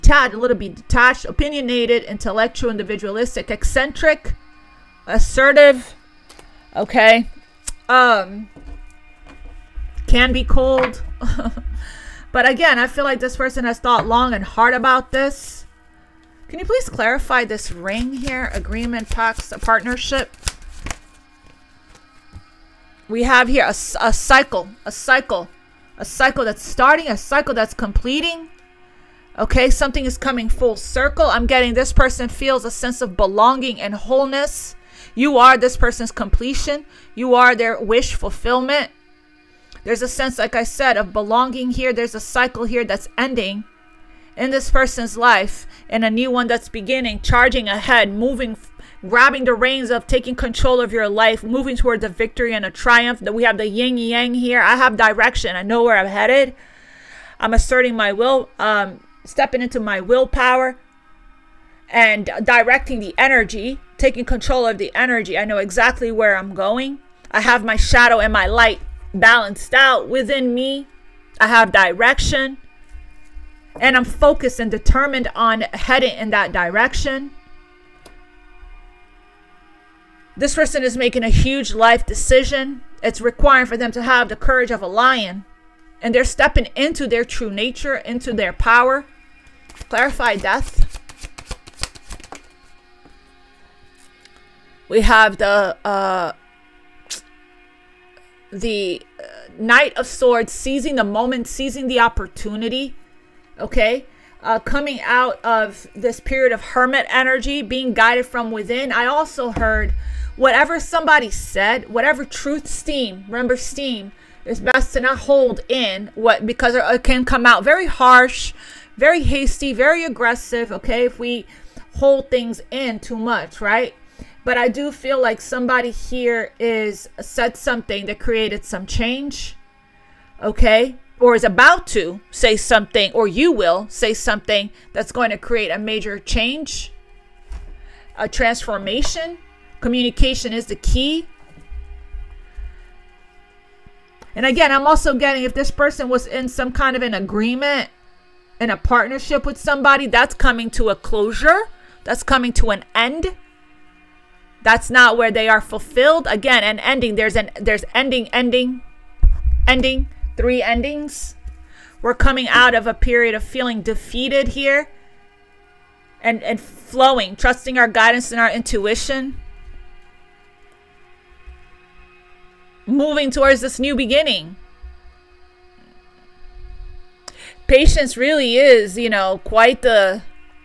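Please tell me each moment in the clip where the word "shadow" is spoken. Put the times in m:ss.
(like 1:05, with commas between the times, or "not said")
1:07.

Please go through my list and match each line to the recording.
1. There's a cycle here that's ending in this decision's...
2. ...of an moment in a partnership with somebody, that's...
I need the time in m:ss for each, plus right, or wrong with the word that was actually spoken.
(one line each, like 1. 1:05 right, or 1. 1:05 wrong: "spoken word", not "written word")
1. 0:41 wrong: "person", not "decision"
2. 2:26 wrong: "agreement", not "moment".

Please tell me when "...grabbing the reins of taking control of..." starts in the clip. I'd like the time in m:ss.
0:49.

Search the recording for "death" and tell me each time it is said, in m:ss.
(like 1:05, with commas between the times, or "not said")
1:30.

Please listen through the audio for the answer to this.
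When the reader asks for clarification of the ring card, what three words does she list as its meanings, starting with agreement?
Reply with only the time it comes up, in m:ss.
0:18.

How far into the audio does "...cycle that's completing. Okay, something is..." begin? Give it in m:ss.
0:27.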